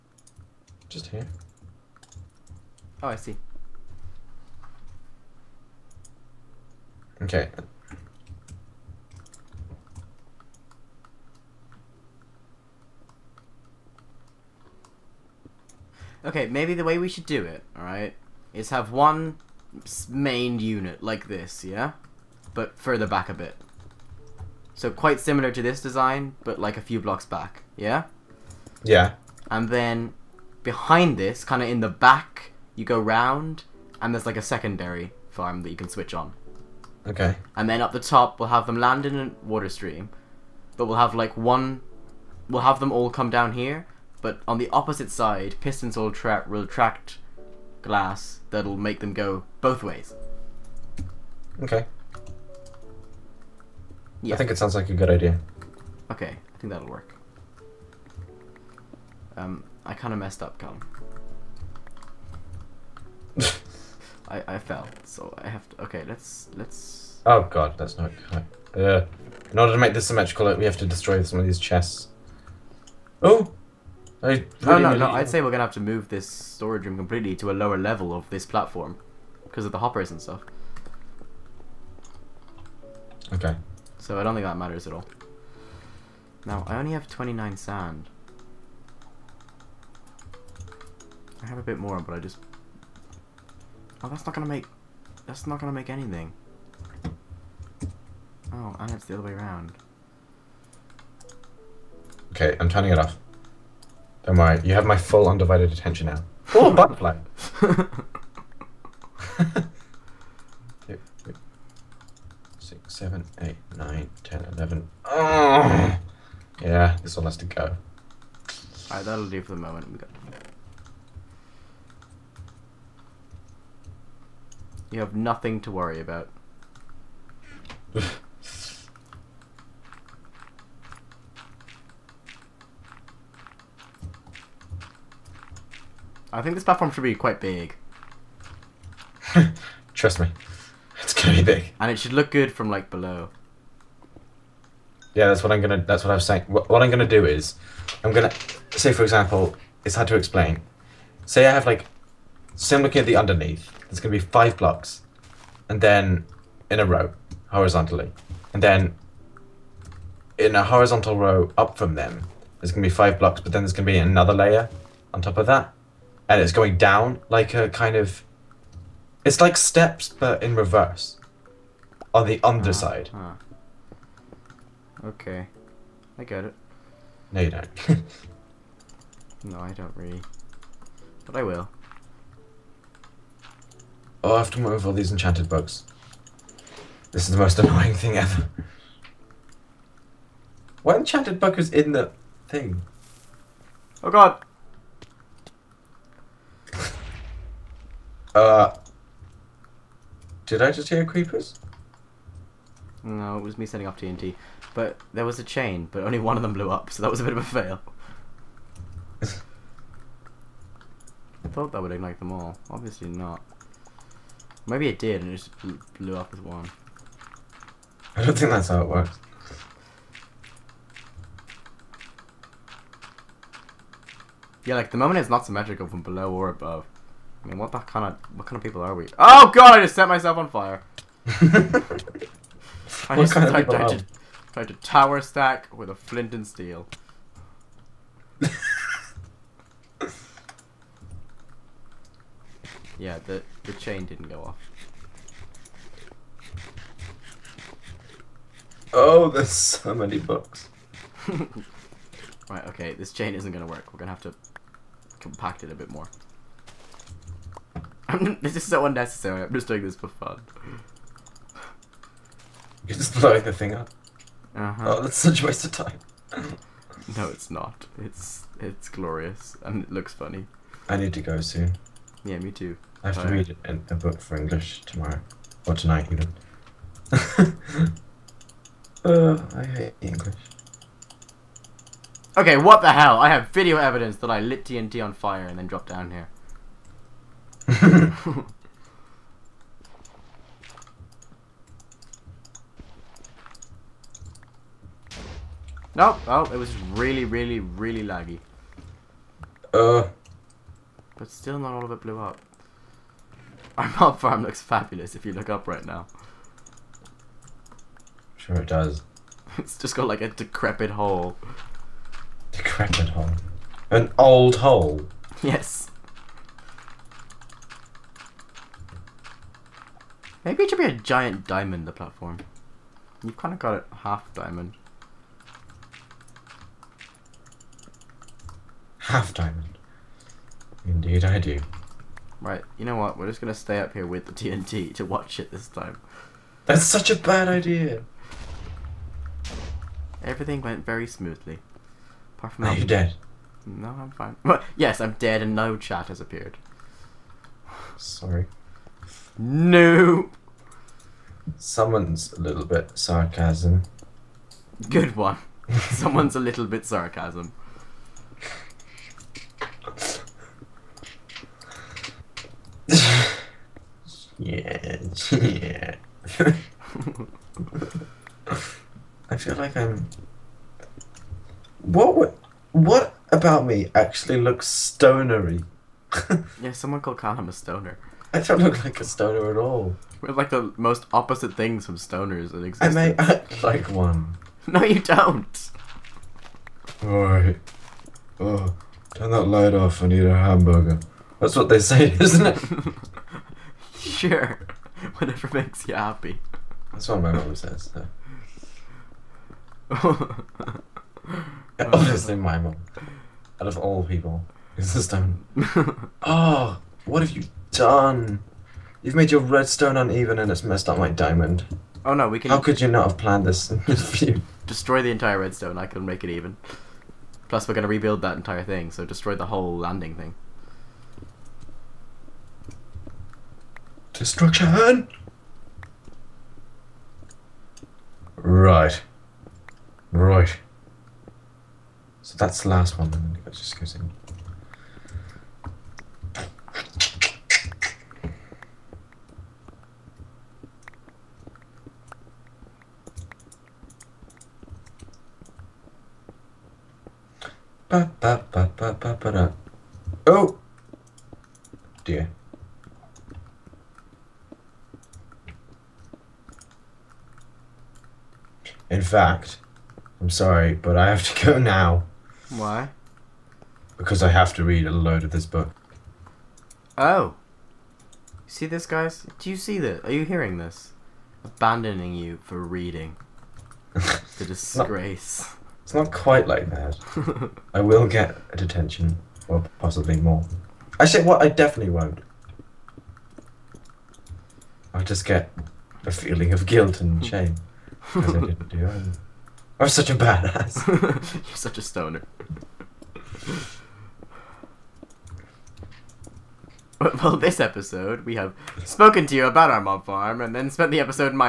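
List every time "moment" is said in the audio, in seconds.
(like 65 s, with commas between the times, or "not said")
119 s, 224 s.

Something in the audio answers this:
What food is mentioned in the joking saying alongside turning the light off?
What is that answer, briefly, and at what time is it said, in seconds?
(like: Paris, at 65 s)
hamburger, at 390 s.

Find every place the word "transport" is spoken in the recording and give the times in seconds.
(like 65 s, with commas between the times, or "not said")
not said.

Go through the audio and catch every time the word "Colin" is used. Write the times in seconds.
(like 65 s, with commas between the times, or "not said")
60 s.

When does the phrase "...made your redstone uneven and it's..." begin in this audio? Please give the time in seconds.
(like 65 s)
409 s.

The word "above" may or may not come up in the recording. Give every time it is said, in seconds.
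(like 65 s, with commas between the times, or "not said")
226 s.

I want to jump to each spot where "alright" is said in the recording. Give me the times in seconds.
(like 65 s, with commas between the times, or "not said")
17 s, 118 s, 387 s.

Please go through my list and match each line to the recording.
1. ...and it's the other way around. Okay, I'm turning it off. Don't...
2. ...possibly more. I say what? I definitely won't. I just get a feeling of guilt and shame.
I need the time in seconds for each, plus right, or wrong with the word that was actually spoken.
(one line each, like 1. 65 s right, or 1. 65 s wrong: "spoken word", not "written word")
1. 98 s right
2. 479 s right.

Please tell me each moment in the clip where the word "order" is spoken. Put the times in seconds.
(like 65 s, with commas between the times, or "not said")
69 s.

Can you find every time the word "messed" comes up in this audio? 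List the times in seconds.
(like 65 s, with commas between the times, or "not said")
60 s, 410 s.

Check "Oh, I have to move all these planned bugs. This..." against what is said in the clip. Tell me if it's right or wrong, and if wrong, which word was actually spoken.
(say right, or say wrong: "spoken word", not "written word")
wrong: "enchanted", not "planned".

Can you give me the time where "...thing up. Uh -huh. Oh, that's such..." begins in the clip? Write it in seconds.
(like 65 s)
263 s.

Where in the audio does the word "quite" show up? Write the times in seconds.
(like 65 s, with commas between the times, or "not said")
24 s, 137 s, 476 s.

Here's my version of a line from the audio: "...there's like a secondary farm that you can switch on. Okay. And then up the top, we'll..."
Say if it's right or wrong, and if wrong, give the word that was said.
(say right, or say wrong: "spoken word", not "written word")
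right.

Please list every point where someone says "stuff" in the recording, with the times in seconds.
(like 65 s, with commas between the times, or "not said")
80 s.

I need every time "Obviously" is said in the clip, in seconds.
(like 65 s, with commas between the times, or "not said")
212 s, 401 s.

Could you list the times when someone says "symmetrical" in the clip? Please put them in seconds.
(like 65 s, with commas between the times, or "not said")
70 s, 225 s.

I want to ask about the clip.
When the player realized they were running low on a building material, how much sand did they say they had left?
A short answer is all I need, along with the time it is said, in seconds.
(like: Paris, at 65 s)
29, at 87 s.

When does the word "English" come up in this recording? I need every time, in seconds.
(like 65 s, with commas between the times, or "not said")
274 s, 279 s.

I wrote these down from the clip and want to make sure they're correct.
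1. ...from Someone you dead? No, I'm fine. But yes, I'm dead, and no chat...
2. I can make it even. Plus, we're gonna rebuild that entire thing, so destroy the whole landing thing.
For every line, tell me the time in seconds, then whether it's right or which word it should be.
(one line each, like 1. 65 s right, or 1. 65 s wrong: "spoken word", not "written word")
1. 342 s wrong: "Are", not "Someone"
2. 415 s right.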